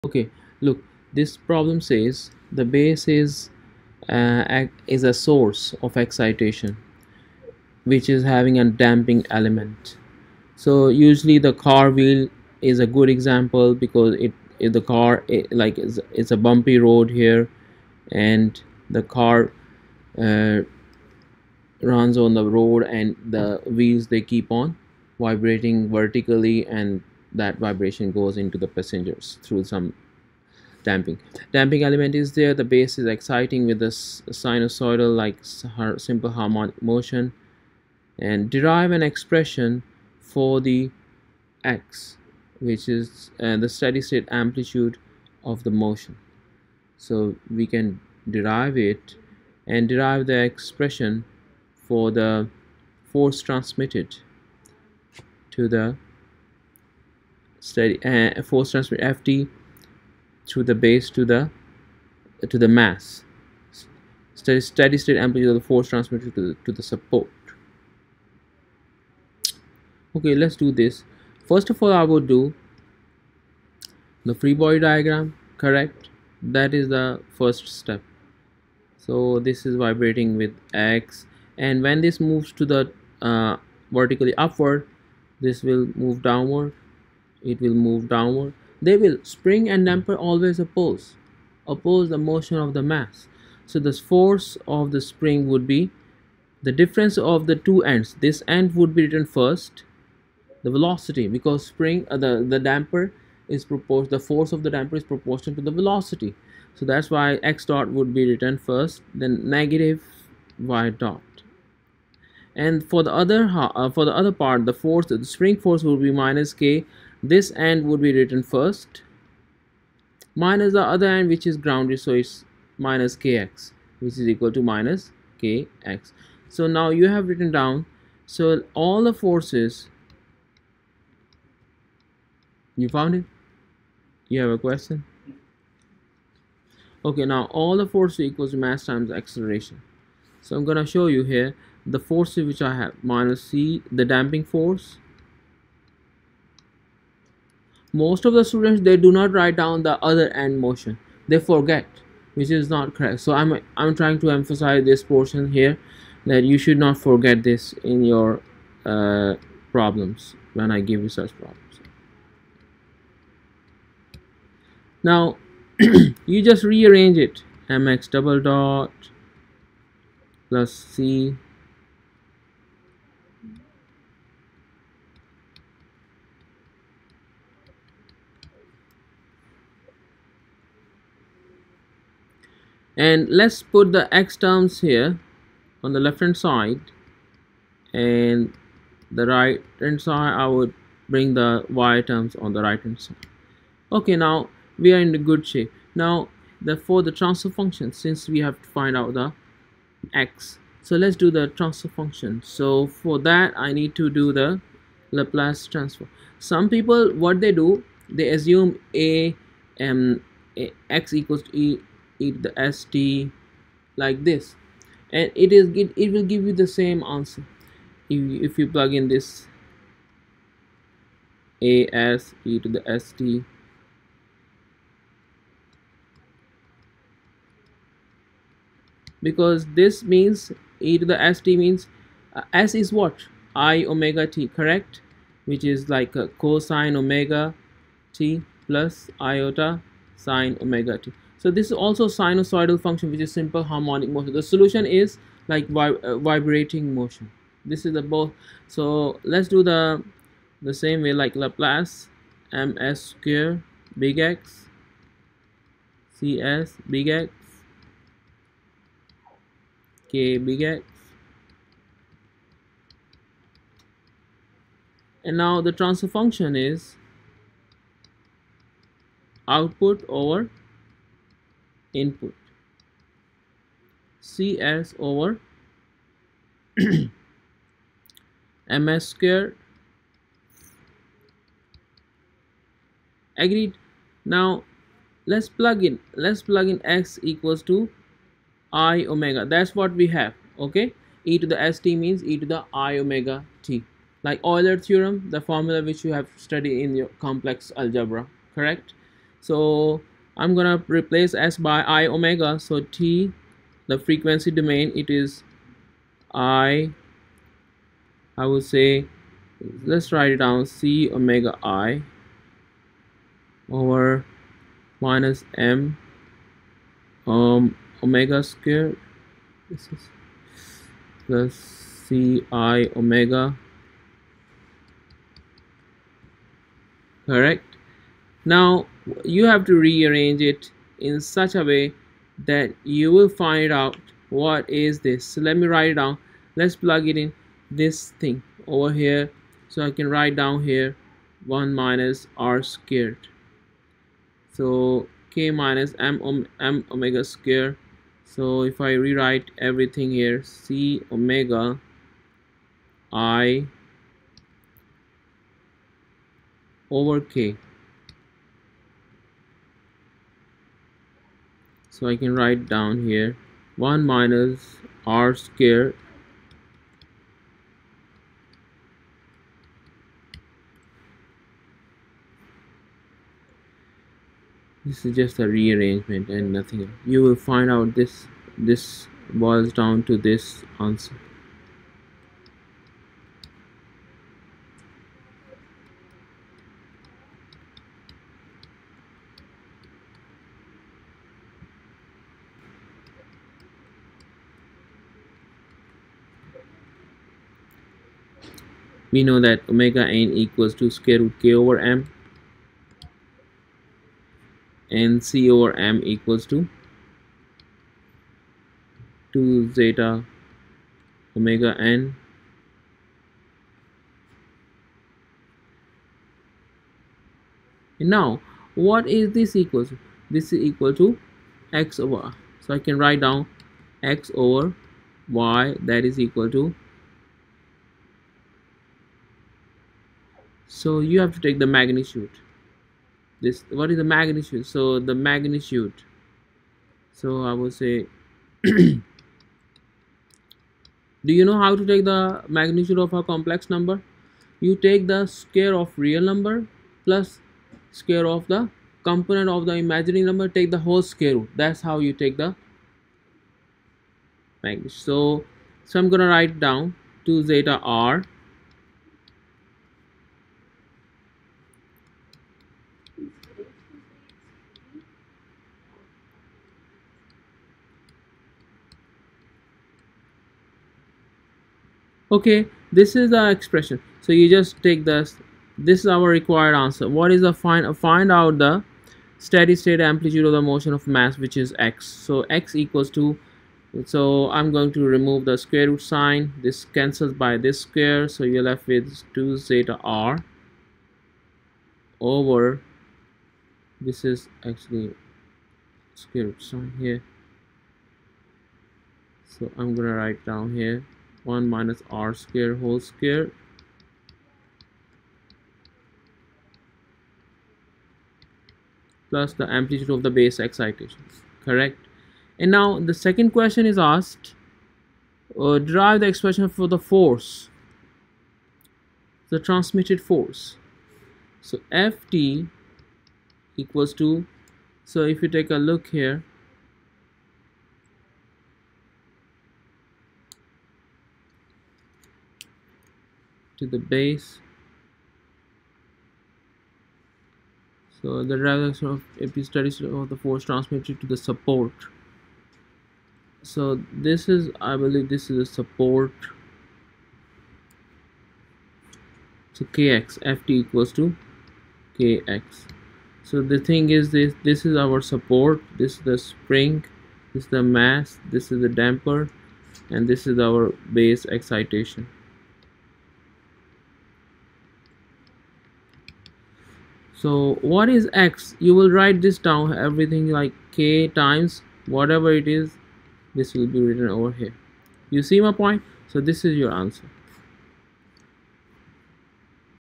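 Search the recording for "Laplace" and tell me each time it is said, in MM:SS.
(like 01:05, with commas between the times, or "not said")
03:25, 04:11.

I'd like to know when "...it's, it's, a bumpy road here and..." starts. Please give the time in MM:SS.
00:15.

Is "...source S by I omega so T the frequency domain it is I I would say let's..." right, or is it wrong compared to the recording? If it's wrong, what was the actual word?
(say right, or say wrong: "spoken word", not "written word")
wrong: "replace", not "source".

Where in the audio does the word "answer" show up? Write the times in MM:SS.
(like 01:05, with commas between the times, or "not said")
03:37, 06:20, 07:56, 09:36.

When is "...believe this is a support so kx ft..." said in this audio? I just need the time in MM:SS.
09:04.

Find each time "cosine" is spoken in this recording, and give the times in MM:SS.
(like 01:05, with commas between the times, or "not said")
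03:56.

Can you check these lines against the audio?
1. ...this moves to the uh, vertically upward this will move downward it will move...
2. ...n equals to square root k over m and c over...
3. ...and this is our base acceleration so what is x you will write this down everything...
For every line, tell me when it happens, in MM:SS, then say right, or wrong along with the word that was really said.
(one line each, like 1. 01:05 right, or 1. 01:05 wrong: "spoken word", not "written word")
1. 01:22 right
2. 06:40 right
3. 09:20 wrong: "excitation", not "acceleration".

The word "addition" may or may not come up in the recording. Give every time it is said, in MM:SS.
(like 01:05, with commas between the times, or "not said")
not said.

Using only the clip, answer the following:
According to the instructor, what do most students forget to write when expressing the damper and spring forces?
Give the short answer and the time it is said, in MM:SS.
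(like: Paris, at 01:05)
The other end motion, at 02:29.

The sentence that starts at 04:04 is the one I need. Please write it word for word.
The solution is like vib uh, vibrating motion.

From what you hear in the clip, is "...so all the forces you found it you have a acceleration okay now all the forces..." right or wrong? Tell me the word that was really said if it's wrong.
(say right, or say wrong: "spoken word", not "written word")
wrong: "question", not "acceleration".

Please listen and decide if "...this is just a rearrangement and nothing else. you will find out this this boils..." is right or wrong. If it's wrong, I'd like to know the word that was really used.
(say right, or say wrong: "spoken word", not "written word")
right.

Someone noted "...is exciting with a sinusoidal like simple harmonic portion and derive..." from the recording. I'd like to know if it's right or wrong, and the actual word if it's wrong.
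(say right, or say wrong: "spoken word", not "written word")
wrong: "motion", not "portion".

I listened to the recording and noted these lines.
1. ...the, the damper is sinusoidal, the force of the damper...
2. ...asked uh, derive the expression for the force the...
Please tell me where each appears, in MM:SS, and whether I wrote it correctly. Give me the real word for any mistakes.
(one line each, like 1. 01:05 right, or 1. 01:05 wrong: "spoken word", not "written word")
1. 01:42 wrong: "proportional", not "sinusoidal"
2. 08:33 right.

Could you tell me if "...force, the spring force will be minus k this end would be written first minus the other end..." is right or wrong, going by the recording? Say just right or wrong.
right.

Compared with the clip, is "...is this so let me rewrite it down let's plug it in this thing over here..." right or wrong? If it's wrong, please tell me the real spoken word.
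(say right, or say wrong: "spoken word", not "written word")
wrong: "write", not "rewrite".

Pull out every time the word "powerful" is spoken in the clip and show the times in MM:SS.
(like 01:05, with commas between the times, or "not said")
not said.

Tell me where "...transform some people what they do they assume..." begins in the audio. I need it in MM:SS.
03:25.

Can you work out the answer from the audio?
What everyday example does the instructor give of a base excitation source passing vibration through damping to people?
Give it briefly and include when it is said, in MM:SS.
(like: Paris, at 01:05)
Car wheel, at 00:11.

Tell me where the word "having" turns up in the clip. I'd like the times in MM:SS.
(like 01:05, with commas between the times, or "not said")
00:08.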